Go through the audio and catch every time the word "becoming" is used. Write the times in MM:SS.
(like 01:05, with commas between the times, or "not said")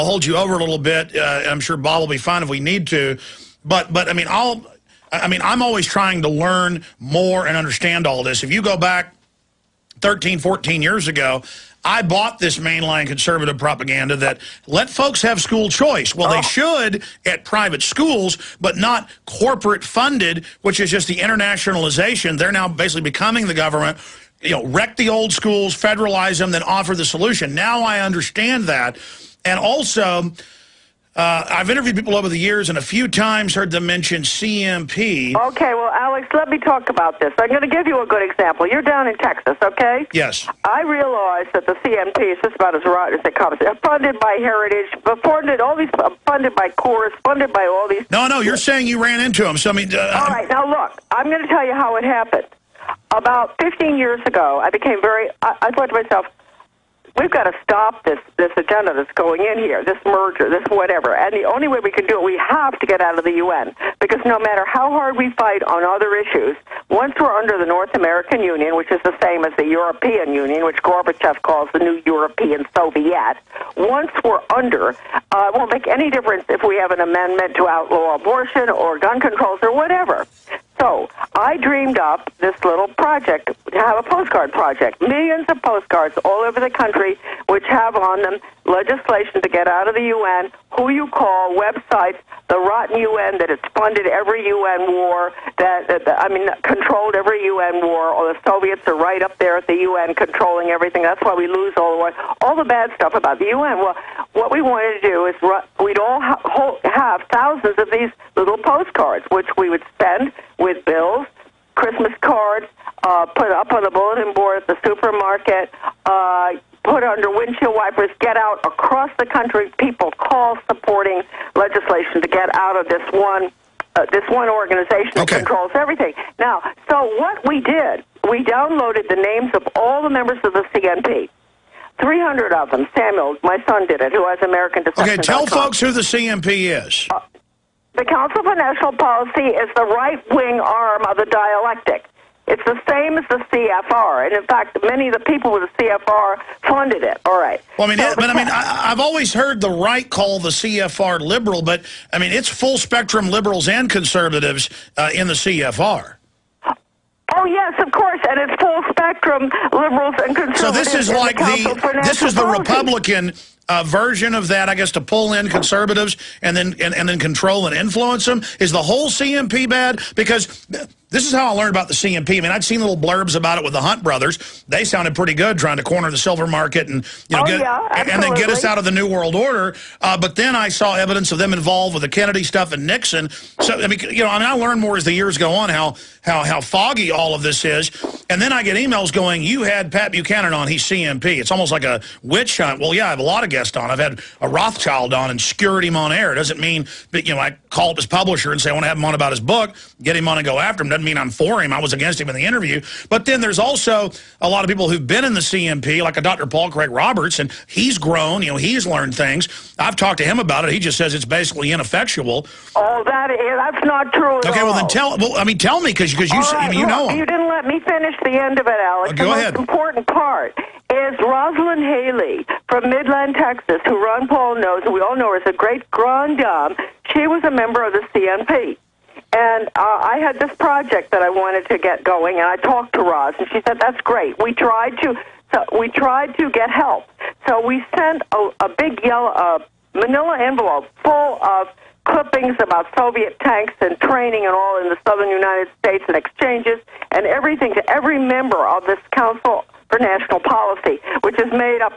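00:23.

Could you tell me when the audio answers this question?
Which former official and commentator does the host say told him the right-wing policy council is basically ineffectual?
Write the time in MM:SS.
03:26.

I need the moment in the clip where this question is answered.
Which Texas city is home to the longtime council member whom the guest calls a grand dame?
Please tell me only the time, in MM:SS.
03:42.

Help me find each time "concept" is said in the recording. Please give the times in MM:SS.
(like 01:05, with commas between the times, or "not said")
not said.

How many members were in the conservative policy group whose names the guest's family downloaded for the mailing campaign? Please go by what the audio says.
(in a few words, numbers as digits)
300.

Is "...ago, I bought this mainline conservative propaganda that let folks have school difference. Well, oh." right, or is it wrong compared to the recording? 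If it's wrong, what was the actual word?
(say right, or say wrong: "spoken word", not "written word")
wrong: "choice", not "difference".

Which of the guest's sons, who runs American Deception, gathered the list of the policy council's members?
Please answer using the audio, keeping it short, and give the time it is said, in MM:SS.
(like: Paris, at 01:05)
Samuel, at 02:12.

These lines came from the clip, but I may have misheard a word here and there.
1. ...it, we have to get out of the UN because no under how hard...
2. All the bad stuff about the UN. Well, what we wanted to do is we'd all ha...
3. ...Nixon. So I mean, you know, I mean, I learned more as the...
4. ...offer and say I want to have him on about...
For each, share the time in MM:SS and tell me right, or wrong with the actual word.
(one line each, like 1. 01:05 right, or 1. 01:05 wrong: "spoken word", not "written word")
1. 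01:02 wrong: "matter", not "under"
2. 01:42 right
3. 03:02 right
4. 03:18 wrong: "publisher", not "offer".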